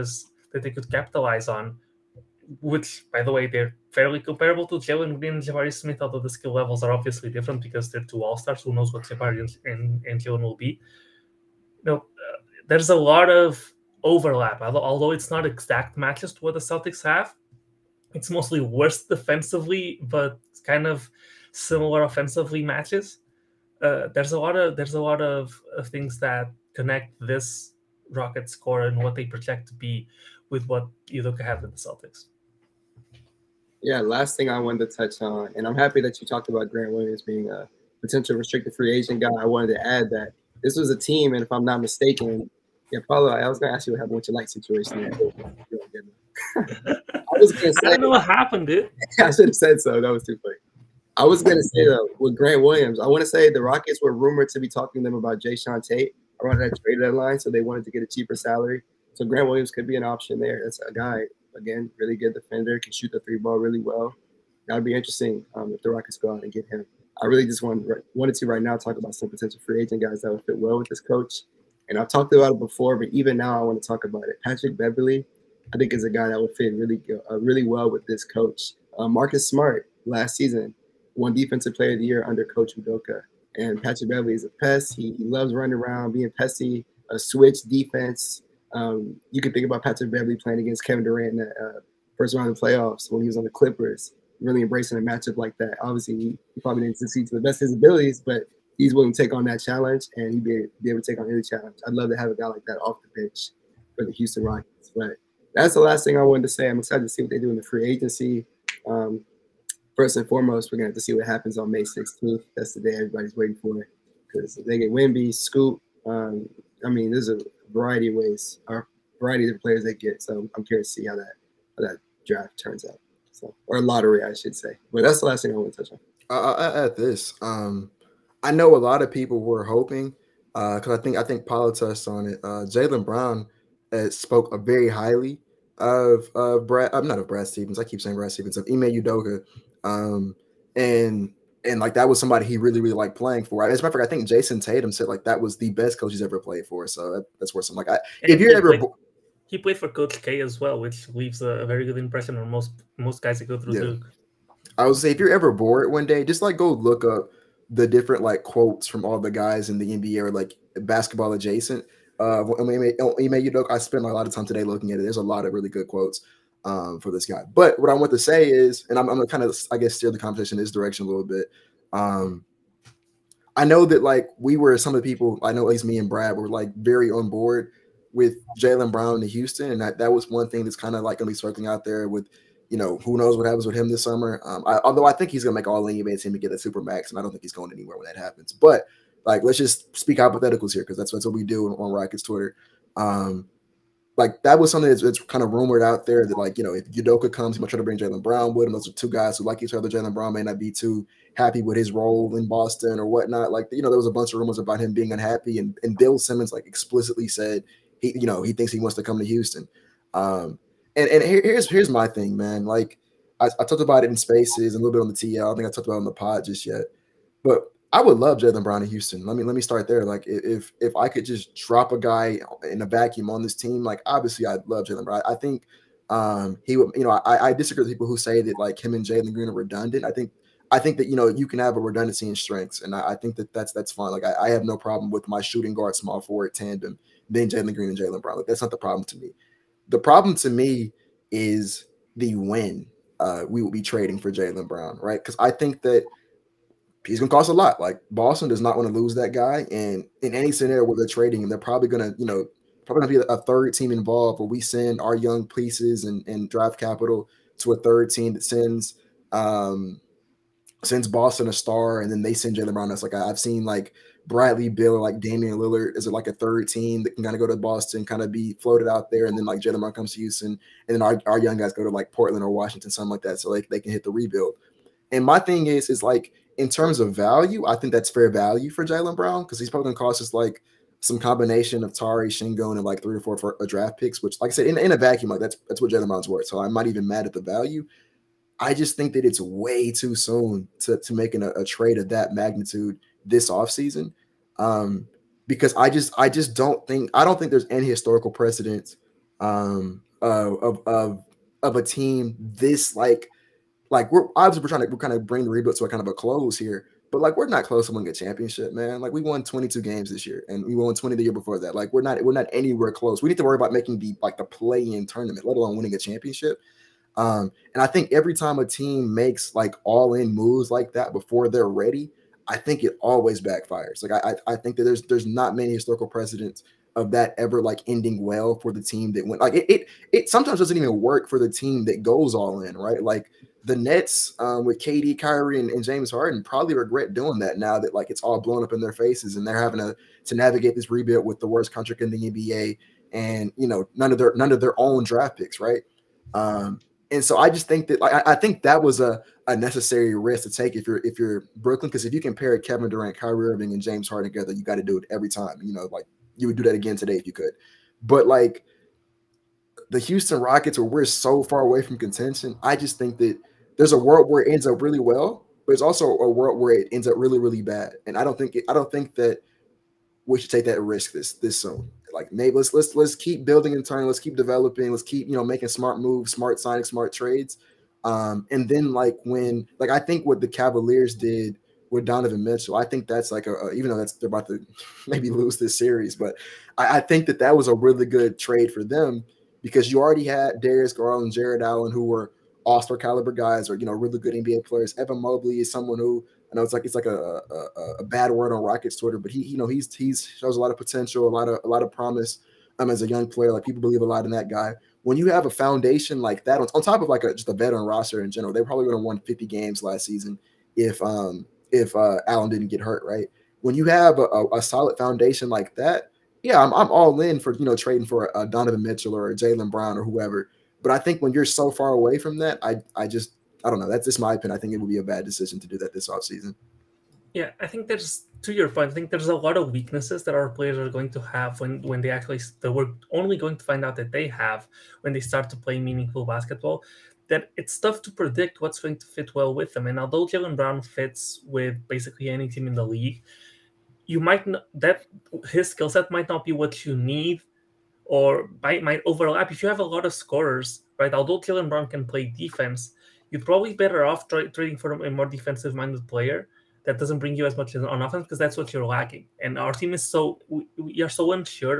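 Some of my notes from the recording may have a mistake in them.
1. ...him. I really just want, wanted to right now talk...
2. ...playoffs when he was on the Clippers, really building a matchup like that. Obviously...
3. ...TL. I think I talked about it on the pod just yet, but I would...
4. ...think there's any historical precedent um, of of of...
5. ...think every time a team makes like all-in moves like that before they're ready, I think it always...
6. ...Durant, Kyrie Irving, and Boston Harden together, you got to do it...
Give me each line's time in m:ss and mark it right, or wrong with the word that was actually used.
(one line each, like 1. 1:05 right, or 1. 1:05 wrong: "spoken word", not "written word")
1. 1:06 right
2. 1:32 wrong: "embracing", not "building"
3. 3:35 right
4. 4:57 right
5. 5:17 right
6. 5:52 wrong: "James", not "Boston".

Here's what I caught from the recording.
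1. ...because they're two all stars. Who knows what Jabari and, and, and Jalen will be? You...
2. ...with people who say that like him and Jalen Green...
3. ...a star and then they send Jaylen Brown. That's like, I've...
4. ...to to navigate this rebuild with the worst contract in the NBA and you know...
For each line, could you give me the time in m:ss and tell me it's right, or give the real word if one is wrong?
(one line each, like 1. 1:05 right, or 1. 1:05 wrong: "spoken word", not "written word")
1. 0:07 right
2. 3:47 right
3. 4:21 right
4. 5:39 right.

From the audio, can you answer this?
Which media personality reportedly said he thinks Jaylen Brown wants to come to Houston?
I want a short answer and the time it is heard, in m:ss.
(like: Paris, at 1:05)
Bill Simmons, at 3:25.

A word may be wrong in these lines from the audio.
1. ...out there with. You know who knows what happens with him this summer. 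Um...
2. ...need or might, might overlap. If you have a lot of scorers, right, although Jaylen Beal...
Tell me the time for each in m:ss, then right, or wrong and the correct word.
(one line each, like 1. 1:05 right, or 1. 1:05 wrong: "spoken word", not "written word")
1. 3:01 right
2. 7:26 wrong: "Brown", not "Beal".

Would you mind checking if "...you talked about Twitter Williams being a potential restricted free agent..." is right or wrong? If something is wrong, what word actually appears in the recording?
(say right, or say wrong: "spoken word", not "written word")
wrong: "Grant", not "Twitter".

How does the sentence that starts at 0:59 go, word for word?
So Grant Williams could be an option there.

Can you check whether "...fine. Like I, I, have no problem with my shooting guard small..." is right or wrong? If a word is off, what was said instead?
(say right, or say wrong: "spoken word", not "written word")
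right.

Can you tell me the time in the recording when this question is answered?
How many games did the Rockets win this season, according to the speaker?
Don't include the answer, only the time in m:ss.
5:09.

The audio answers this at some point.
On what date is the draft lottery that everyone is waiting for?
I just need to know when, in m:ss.
1:51.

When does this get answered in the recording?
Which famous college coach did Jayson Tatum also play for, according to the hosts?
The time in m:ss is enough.
2:29.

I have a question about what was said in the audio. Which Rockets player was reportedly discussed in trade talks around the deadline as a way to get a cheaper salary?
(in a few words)
Jae'Sean Tate.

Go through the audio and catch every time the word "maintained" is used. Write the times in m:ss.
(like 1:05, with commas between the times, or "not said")
not said.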